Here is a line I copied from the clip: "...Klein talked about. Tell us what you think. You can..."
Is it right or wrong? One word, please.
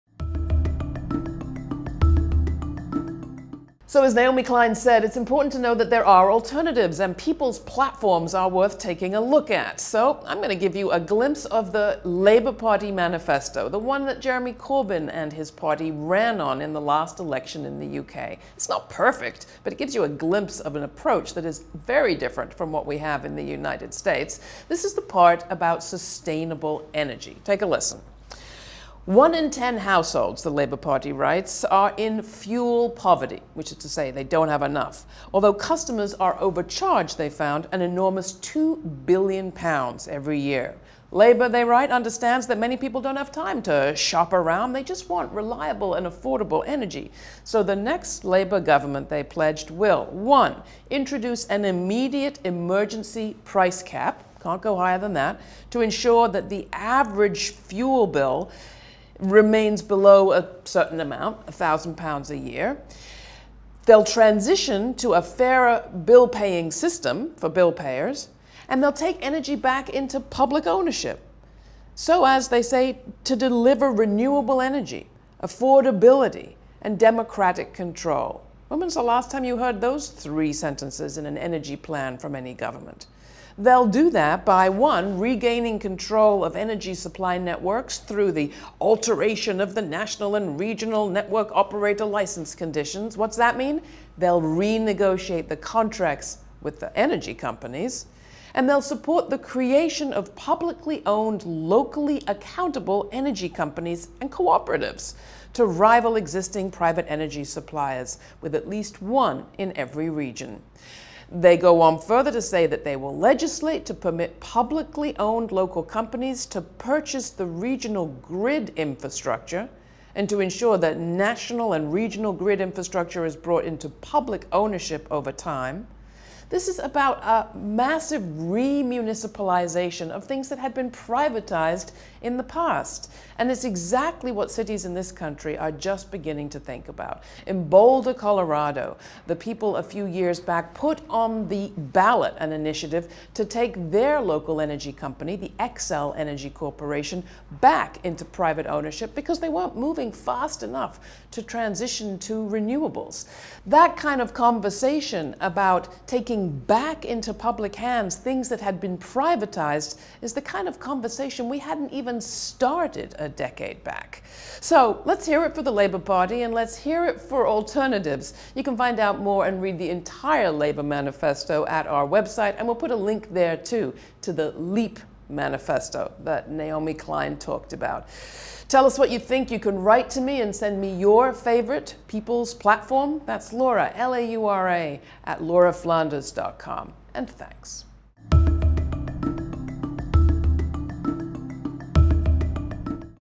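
right.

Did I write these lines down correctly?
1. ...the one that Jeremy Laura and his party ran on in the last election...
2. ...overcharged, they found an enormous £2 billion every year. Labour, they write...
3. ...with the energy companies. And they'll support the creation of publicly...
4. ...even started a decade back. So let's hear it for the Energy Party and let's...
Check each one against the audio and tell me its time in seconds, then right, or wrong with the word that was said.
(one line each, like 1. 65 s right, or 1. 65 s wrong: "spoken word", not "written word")
1. 13 s wrong: "Corbyn", not "Laura"
2. 36 s right
3. 96 s right
4. 161 s wrong: "Labour", not "Energy".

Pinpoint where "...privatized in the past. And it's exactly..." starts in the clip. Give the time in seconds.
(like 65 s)
130 s.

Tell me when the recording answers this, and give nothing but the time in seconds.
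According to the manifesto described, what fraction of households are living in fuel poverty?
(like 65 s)
29 s.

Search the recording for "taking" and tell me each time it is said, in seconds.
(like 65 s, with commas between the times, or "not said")
8 s, 156 s.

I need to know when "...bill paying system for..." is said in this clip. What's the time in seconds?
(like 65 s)
66 s.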